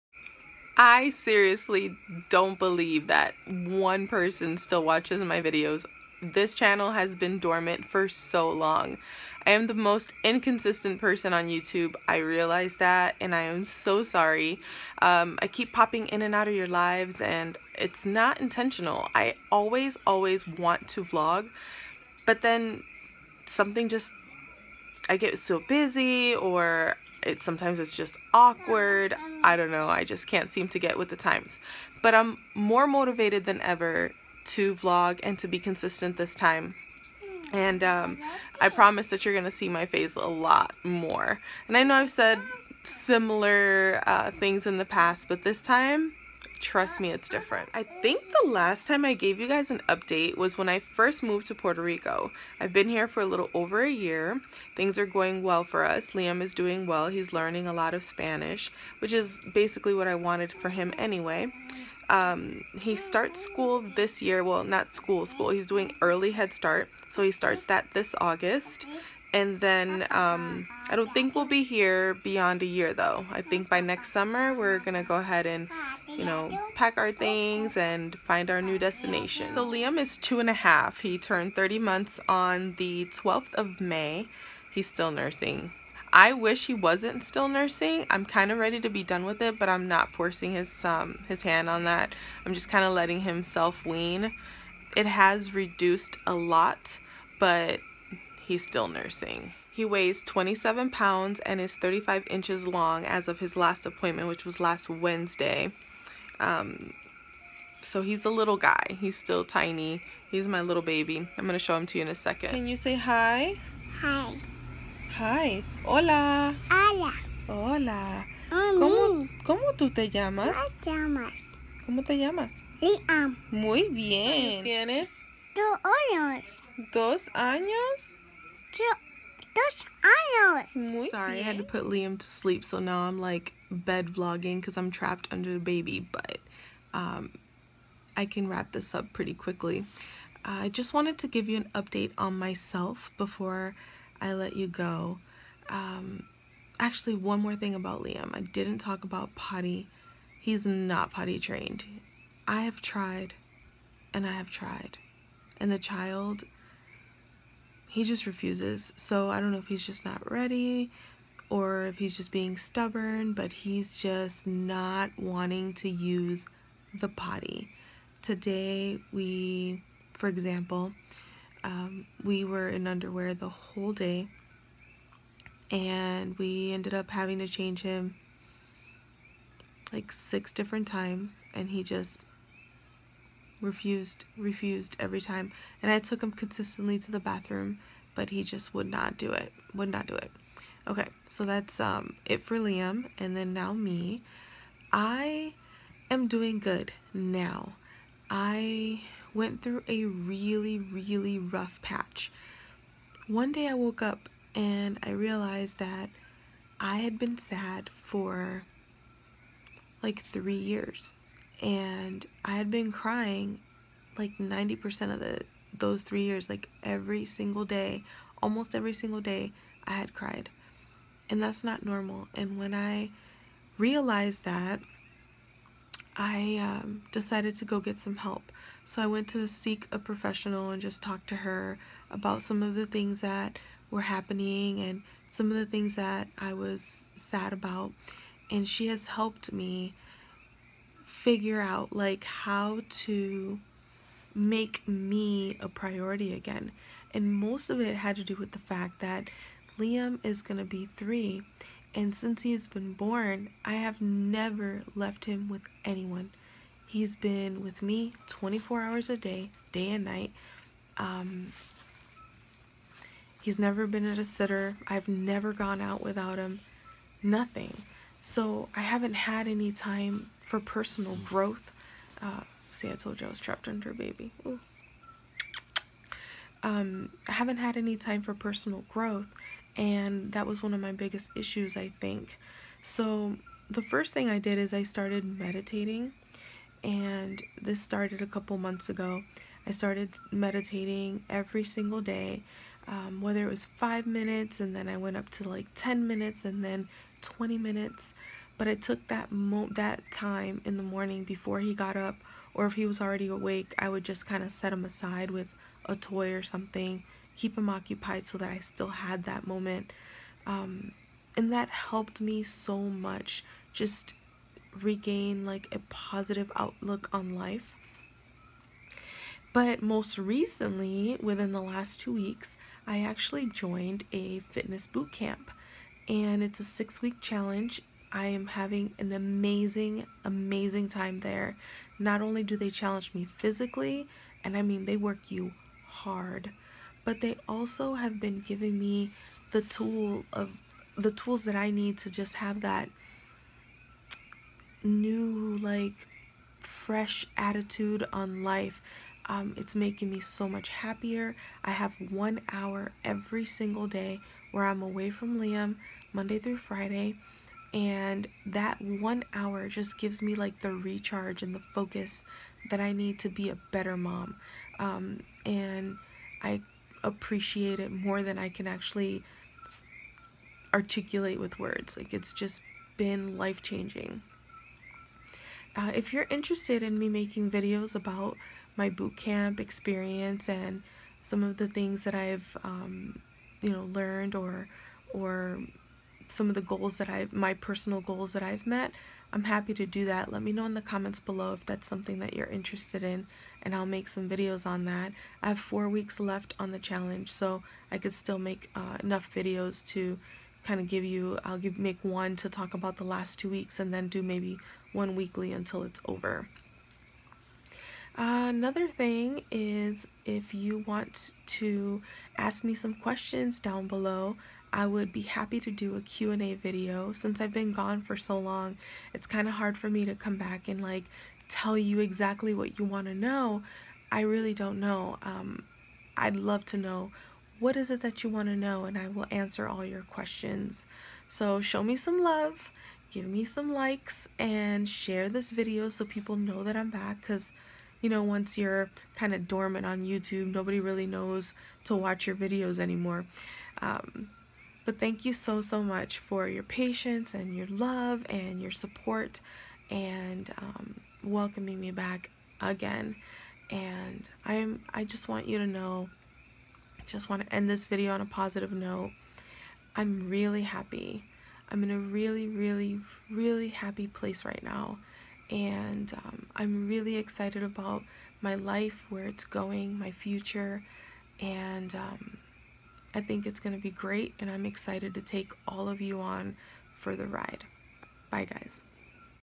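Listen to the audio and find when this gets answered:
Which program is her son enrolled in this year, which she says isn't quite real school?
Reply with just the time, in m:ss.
1:06.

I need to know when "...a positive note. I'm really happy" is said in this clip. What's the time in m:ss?
7:38.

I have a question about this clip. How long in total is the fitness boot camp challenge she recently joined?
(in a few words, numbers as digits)
6 weeks.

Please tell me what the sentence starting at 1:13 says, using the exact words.
I think by next summer we're gonna go ahead and you know, pack our things and find our new destination.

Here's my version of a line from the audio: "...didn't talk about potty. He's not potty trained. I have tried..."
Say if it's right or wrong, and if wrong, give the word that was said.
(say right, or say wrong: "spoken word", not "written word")
right.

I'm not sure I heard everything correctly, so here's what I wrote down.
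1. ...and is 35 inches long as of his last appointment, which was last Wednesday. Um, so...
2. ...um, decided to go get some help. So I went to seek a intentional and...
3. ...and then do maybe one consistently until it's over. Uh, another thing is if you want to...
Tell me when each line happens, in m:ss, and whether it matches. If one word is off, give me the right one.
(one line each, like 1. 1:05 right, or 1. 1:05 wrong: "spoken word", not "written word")
1. 1:41 right
2. 3:46 wrong: "professional", not "intentional"
3. 6:43 wrong: "weekly", not "consistently".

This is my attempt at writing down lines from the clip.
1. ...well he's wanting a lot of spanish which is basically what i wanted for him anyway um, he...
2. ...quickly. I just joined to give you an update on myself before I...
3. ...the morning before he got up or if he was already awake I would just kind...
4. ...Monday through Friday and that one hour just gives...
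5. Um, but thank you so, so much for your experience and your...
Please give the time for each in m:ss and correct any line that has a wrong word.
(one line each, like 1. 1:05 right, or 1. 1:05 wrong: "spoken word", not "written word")
1. 0:56 wrong: "learning", not "wanting"
2. 2:19 wrong: "wanted", not "joined"
3. 5:00 right
4. 5:56 right
5. 7:23 wrong: "patience", not "experience".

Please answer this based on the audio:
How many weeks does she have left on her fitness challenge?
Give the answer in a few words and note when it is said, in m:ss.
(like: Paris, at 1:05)
4, at 6:35.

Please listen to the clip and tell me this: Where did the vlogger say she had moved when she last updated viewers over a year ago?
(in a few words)
Puerto Rico.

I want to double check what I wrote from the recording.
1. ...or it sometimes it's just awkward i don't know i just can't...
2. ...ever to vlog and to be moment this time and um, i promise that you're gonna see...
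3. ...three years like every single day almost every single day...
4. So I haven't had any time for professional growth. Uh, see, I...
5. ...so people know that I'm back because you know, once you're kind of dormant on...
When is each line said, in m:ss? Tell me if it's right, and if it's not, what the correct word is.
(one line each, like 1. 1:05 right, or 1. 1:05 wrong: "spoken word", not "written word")
1. 0:26 right
2. 0:33 wrong: "consistent", not "moment"
3. 3:36 right
4. 4:28 wrong: "personal", not "professional"
5. 7:15 right.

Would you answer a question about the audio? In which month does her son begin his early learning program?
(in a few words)
August.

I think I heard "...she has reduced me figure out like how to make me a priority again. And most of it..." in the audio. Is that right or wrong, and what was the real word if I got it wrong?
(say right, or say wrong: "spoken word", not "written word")
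wrong: "helped", not "reduced".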